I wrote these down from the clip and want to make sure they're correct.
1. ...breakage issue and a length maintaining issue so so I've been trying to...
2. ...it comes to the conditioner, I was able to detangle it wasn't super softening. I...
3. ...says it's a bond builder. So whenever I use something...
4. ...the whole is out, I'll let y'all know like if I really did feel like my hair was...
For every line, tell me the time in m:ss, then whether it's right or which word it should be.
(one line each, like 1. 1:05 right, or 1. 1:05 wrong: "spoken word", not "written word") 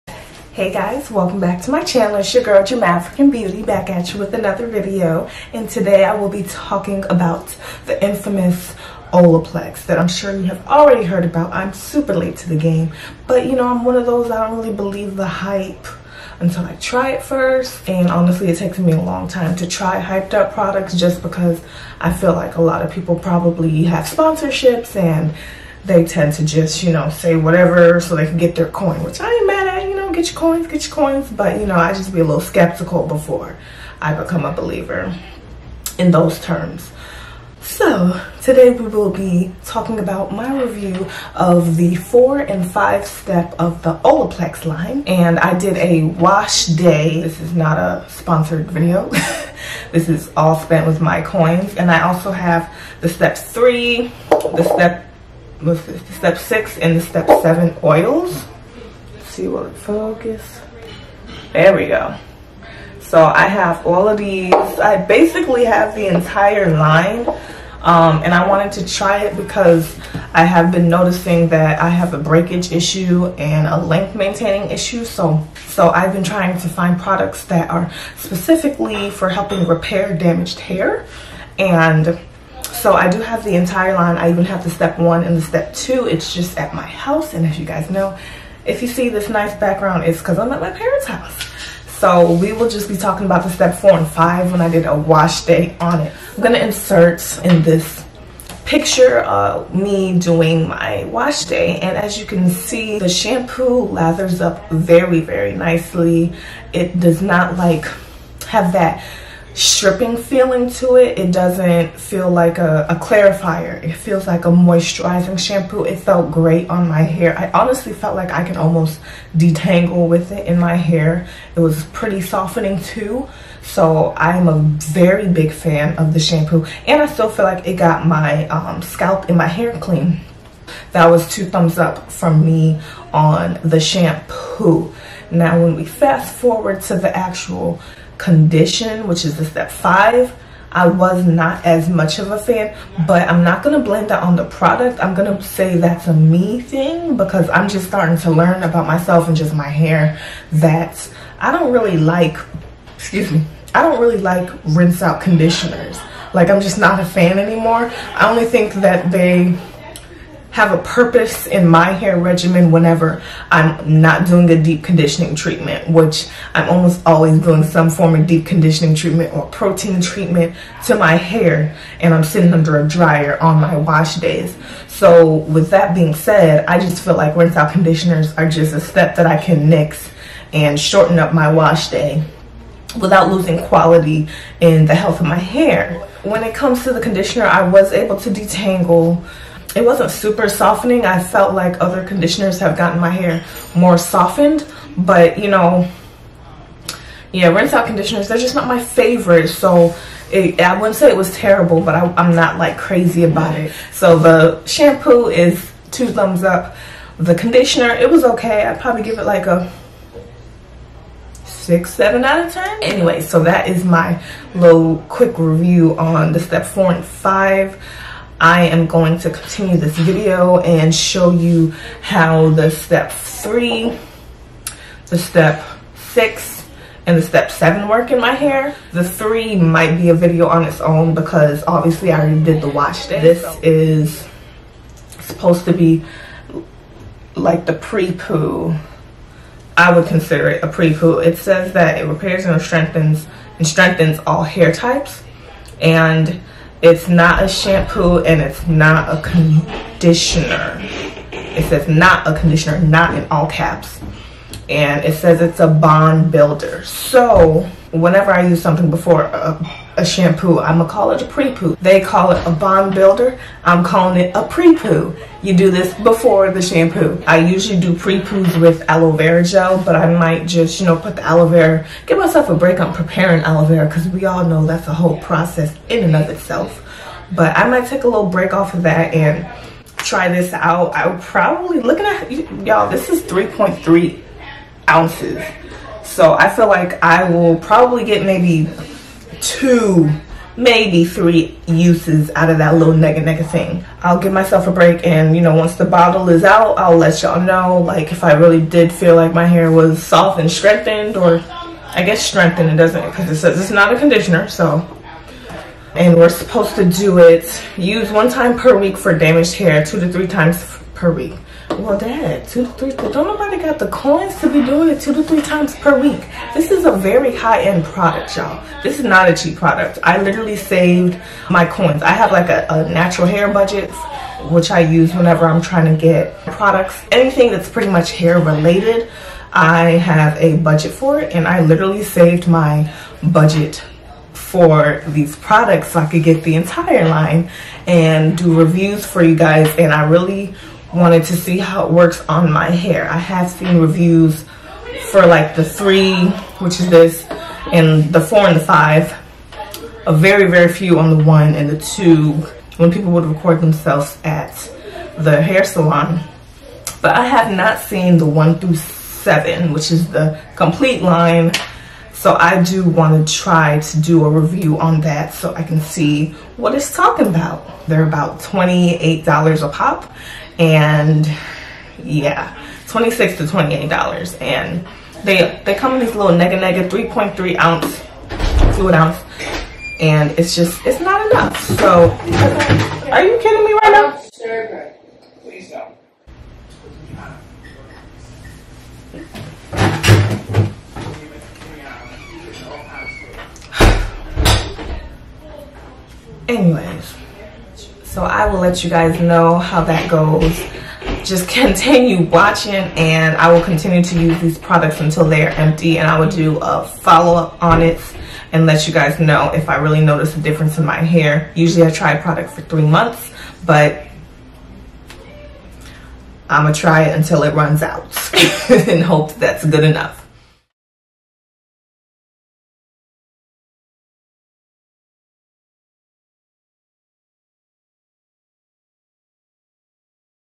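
1. 1:12 right
2. 3:06 right
3. 4:15 right
4. 4:55 wrong: "bottle", not "whole".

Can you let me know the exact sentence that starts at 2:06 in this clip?
And I still feel like it got my um, scalp and my hair clean.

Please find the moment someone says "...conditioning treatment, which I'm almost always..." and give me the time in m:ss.
2:44.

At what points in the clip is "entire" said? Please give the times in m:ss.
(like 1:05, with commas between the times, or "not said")
1:06, 1:23, 5:36.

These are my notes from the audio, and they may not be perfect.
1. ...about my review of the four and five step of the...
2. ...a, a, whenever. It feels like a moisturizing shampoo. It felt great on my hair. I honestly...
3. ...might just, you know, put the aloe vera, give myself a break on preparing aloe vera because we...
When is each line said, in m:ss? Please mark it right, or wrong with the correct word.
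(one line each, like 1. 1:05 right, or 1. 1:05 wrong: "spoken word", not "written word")
1. 0:39 right
2. 1:52 wrong: "clarifier", not "whenever"
3. 4:30 right.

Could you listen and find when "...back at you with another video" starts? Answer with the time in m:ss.
0:03.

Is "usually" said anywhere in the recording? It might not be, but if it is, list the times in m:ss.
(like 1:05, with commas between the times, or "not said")
4:27, 6:51.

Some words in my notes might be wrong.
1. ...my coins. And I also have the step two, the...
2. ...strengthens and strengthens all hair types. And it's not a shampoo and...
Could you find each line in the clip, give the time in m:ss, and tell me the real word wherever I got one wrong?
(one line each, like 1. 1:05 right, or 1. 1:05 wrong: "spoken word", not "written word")
1. 0:51 wrong: "three", not "two"
2. 4:02 right.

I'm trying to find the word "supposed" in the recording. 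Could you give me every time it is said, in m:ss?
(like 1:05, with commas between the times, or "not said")
3:55, 5:06.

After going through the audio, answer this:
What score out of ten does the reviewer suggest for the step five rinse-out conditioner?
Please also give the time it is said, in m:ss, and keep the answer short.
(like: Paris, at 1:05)
6 or 7, at 3:31.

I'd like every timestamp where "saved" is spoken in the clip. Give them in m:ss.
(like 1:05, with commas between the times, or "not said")
5:20, 5:32.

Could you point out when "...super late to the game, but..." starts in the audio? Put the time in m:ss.
0:11.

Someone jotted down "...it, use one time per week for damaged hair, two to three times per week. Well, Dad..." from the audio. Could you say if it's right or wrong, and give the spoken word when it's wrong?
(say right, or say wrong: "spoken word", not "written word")
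right.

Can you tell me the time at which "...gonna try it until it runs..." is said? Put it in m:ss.
6:56.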